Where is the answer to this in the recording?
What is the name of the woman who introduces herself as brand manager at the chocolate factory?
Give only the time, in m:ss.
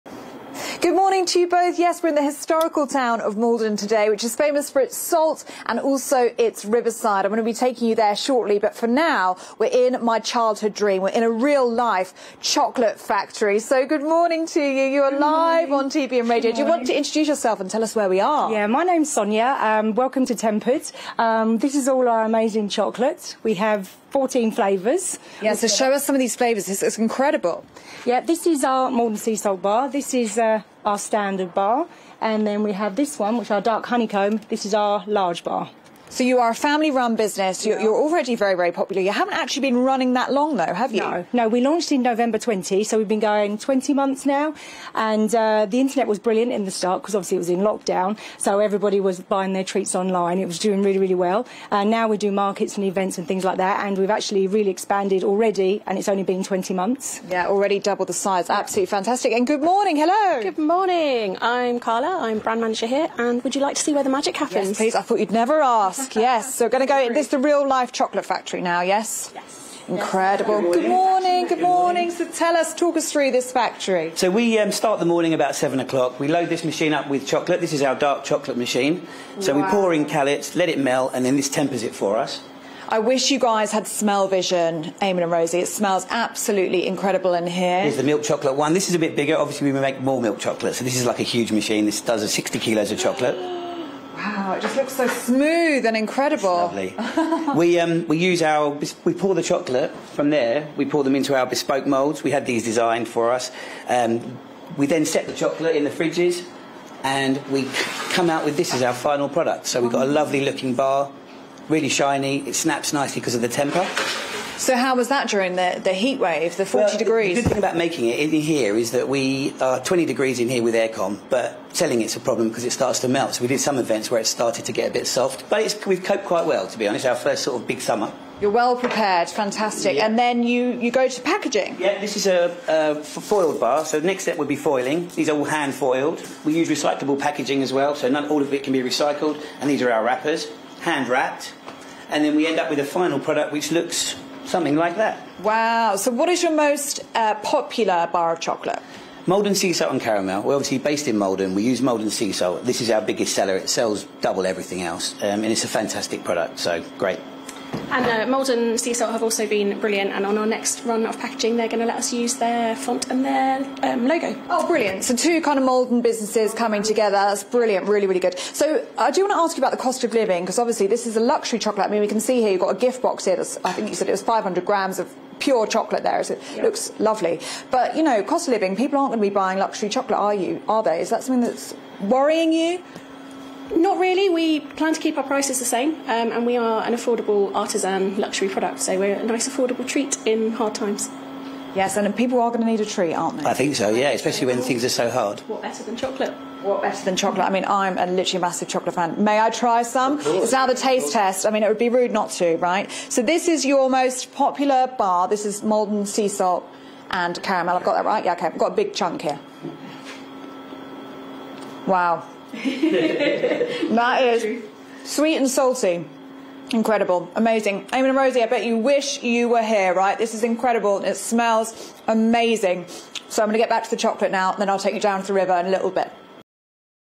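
1:01.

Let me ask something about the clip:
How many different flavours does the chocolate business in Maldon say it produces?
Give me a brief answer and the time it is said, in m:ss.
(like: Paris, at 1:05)
14, at 0:24.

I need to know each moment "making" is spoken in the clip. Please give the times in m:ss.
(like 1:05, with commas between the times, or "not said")
1:57.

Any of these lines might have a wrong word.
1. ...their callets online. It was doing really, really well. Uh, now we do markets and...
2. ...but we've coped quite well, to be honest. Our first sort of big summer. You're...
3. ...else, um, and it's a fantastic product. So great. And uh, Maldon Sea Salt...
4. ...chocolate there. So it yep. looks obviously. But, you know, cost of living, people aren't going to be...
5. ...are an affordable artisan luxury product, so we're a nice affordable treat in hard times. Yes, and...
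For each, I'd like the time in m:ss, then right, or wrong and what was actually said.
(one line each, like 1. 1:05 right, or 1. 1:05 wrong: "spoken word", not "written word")
1. 0:49 wrong: "treats", not "callets"
2. 2:05 right
3. 2:34 right
4. 2:55 wrong: "lovely", not "obviously"
5. 3:06 right.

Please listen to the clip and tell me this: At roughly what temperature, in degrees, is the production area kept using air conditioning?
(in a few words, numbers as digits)
20 degrees.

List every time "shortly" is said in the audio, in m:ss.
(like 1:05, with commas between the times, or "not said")
0:08.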